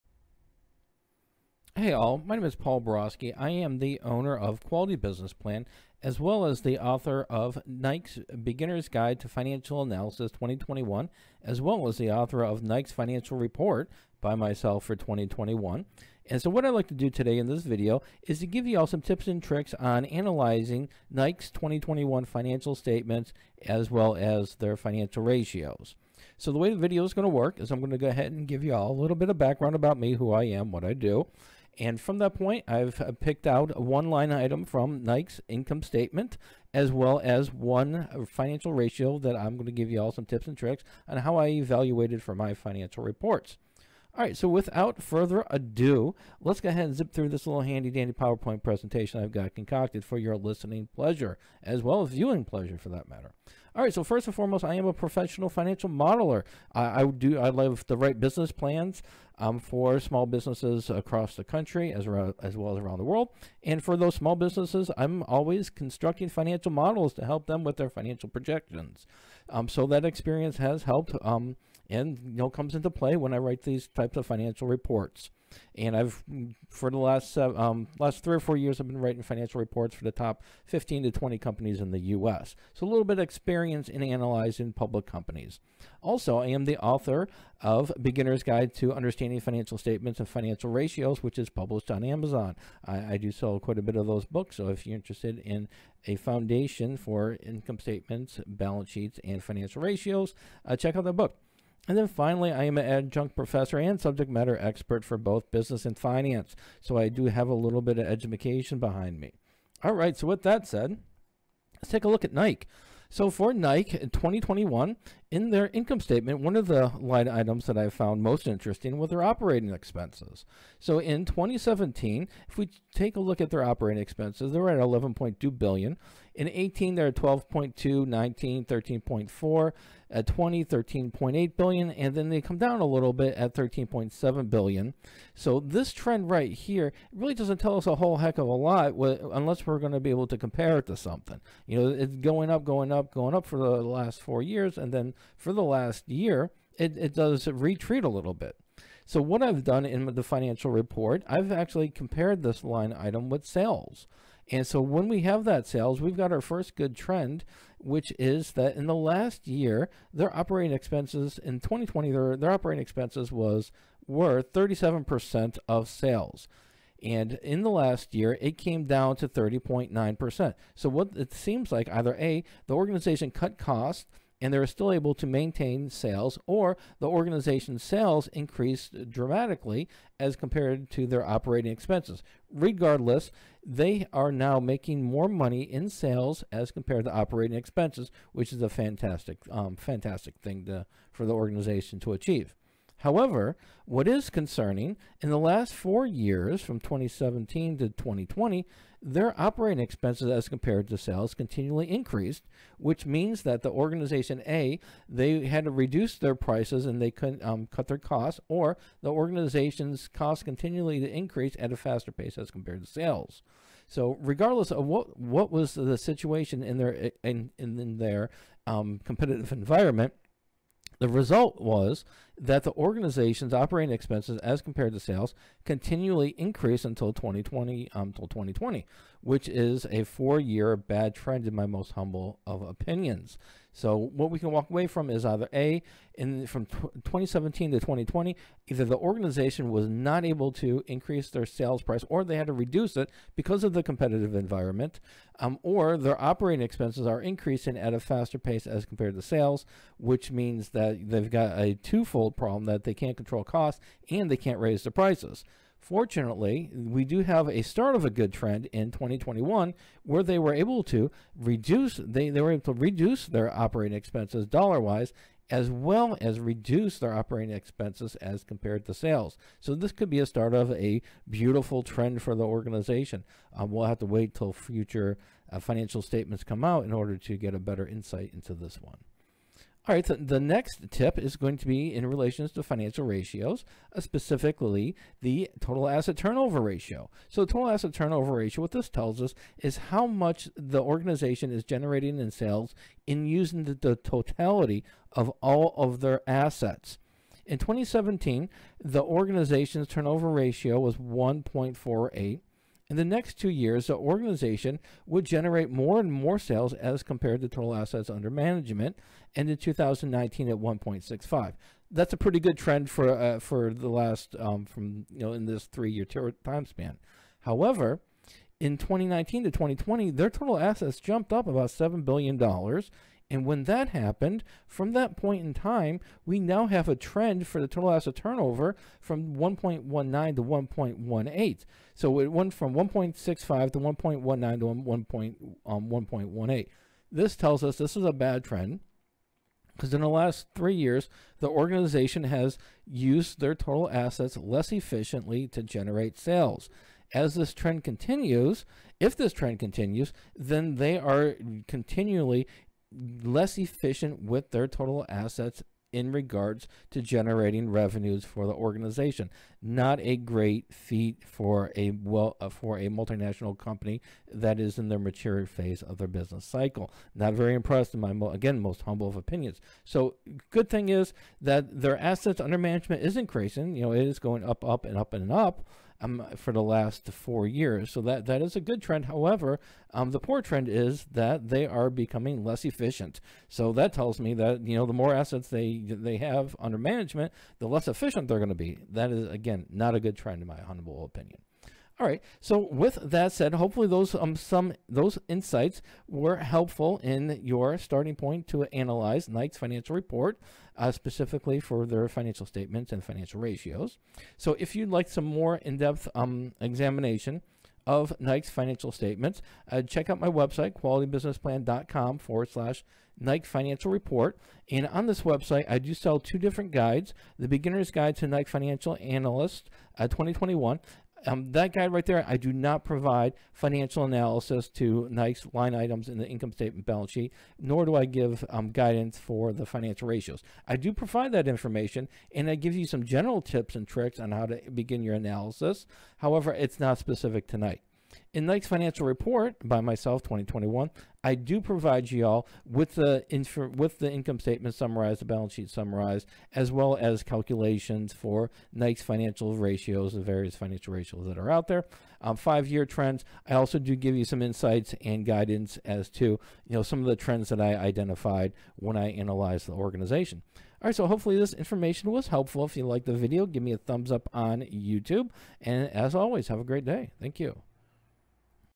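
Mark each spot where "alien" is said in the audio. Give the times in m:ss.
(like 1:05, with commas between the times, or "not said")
not said.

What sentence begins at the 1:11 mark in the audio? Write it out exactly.
Um, and you know comes into play when I write these types of financial reports.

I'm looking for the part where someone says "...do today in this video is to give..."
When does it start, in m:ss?
0:16.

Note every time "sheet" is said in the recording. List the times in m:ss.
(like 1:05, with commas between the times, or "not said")
1:38, 7:07, 7:25.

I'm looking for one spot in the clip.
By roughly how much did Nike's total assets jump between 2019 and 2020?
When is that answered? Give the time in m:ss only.
5:21.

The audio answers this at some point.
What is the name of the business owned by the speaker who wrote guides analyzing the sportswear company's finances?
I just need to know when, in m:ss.
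0:04.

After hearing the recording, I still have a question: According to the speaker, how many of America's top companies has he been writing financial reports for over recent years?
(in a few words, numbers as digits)
15 to 20.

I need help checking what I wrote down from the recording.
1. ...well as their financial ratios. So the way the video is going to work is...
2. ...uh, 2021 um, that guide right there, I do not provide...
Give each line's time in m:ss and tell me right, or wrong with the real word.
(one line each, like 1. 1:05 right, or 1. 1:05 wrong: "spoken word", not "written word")
1. 0:23 right
2. 6:59 right.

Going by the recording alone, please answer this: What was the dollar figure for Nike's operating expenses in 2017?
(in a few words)
11.2 billion.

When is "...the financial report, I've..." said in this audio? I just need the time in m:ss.
2:30.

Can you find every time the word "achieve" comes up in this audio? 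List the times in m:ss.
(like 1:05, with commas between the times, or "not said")
3:12.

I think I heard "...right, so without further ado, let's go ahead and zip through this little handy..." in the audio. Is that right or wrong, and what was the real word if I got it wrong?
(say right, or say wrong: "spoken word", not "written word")
right.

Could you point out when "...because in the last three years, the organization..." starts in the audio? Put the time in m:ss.
5:39.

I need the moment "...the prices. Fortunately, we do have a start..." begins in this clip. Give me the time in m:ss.
4:14.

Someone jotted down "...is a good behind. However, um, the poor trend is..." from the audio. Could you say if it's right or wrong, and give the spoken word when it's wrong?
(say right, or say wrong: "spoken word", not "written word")
wrong: "trend", not "behind".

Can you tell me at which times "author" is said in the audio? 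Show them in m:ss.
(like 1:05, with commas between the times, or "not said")
0:06, 0:12, 1:26.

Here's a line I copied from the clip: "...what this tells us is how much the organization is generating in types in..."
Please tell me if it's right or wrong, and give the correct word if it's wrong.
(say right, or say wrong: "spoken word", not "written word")
wrong: "sales", not "types".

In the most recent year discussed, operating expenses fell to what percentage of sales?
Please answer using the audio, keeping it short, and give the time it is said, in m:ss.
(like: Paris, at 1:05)
30.9%, at 2:49.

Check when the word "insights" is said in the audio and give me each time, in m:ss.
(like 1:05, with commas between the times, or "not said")
4:37, 6:35, 7:34.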